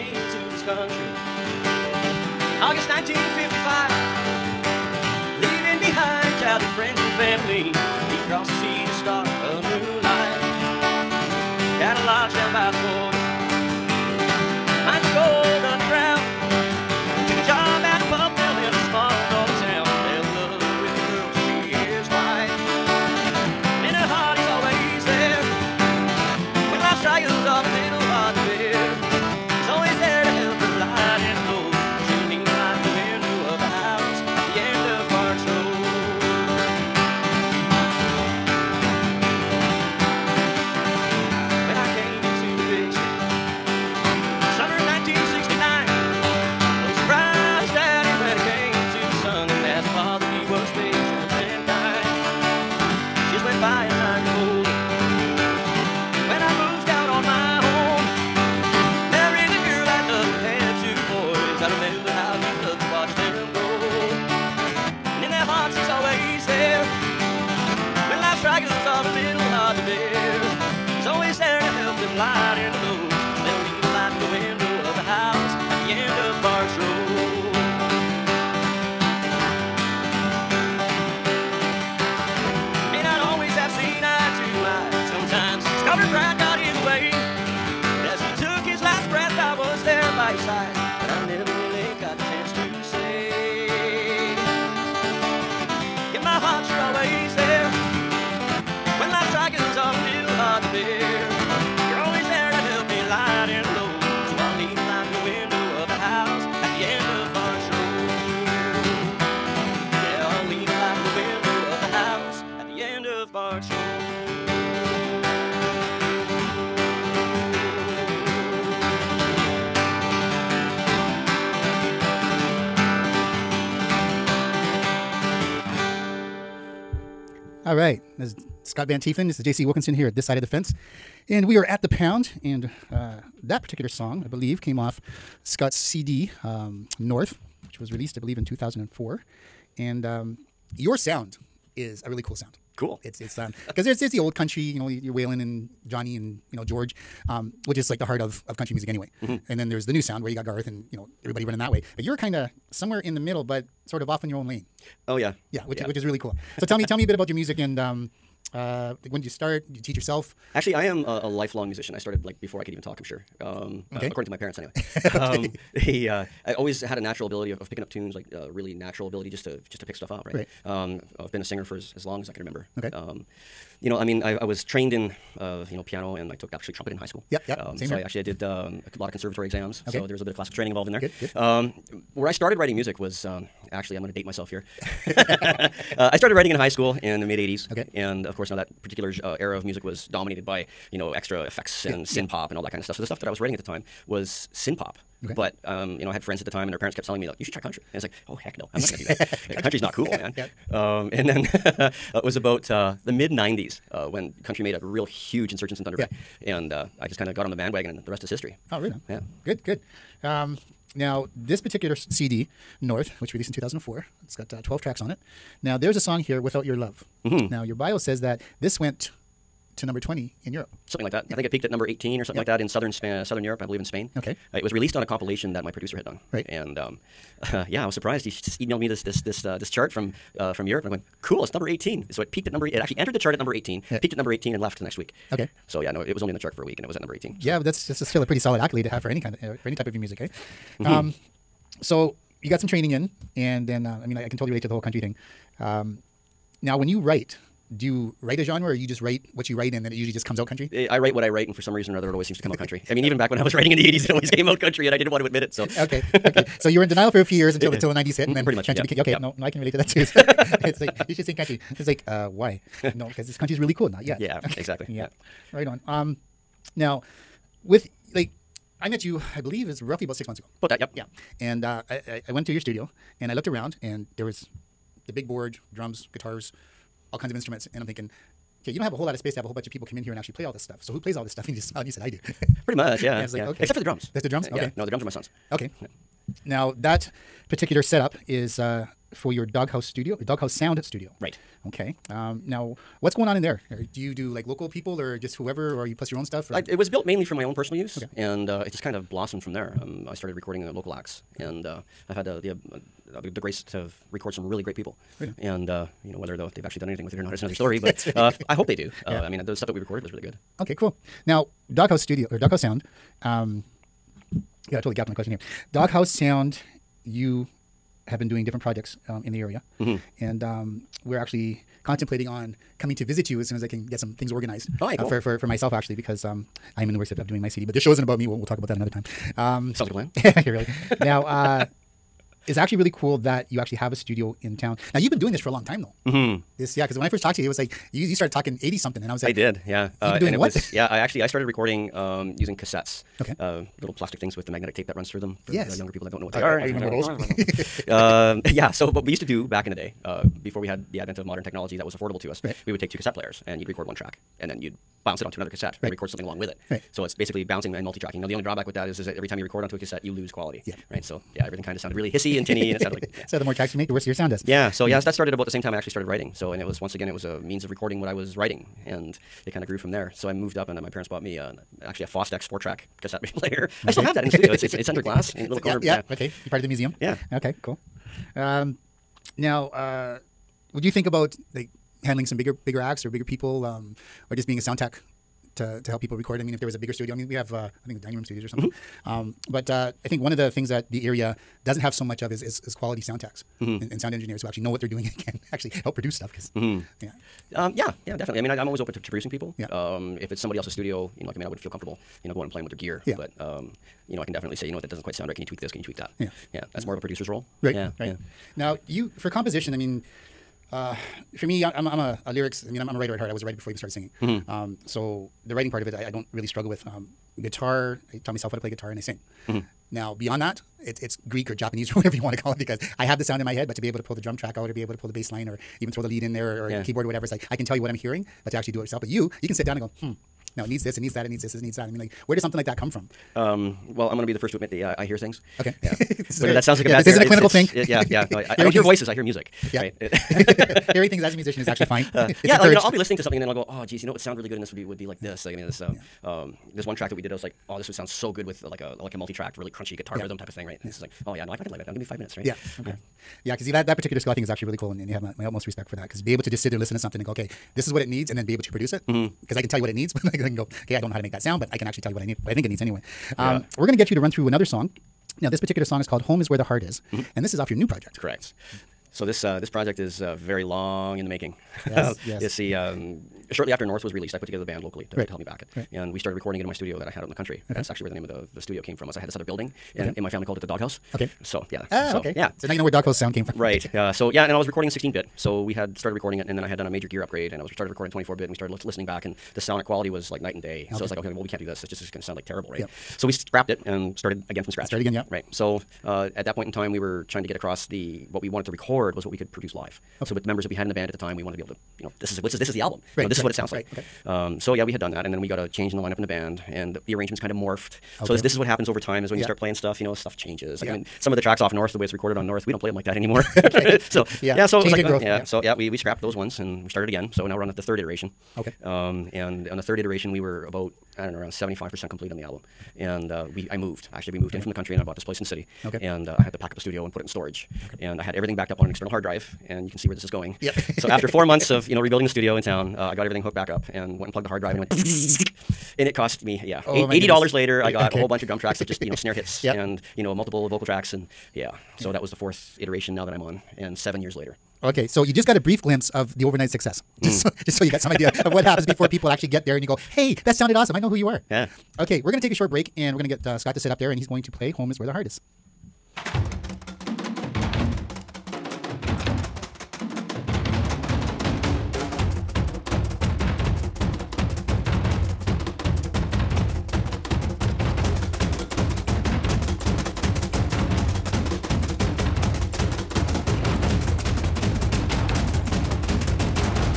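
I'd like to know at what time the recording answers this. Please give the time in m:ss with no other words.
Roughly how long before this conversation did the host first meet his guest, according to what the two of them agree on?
4:30.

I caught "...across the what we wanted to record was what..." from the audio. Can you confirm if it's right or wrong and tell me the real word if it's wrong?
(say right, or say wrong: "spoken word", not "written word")
right.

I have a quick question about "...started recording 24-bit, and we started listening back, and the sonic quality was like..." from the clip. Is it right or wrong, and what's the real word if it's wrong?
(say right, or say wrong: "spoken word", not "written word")
right.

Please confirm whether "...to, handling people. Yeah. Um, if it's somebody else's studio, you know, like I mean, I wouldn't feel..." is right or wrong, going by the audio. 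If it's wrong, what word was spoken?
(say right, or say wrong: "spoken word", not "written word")
wrong: "producing", not "handling".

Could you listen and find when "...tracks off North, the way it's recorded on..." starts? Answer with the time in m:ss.
8:31.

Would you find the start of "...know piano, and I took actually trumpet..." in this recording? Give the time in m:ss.
2:55.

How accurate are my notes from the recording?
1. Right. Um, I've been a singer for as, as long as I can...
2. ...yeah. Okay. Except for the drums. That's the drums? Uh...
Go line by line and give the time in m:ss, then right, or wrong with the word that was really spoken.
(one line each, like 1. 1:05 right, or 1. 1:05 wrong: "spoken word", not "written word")
1. 2:50 right
2. 4:43 right.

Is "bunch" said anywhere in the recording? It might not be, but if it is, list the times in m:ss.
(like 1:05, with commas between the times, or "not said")
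4:39, 8:58.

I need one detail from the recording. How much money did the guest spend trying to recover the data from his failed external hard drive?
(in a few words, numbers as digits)
$80.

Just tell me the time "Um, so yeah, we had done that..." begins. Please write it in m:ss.
8:24.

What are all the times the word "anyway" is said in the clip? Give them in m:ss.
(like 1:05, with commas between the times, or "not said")
2:28, 2:44, 7:42.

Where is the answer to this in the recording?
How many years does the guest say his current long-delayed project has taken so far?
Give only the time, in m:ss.
9:03.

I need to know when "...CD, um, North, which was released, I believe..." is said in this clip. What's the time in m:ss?
2:15.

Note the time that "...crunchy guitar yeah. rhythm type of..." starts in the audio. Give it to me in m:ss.
7:29.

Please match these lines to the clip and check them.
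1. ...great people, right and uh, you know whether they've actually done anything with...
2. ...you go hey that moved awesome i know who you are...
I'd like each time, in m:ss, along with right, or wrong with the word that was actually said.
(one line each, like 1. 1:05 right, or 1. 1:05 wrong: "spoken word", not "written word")
1. 5:04 right
2. 9:09 wrong: "sounded", not "moved".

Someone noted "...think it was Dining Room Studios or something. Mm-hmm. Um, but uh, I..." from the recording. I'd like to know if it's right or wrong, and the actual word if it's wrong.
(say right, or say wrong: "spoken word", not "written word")
right.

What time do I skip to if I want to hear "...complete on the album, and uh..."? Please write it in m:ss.
8:42.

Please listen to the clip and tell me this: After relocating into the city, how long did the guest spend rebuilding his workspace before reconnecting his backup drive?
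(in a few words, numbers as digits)
4 months.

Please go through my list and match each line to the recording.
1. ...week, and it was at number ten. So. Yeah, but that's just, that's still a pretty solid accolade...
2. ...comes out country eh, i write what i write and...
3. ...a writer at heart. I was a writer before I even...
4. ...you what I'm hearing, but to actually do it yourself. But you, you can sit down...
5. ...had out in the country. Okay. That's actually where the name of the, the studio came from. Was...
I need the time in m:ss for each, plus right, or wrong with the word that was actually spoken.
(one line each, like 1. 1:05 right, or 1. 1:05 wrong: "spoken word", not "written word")
1. 3:56 wrong: "eighteen", not "ten"
2. 4:10 right
3. 6:52 right
4. 7:07 right
5. 7:57 right.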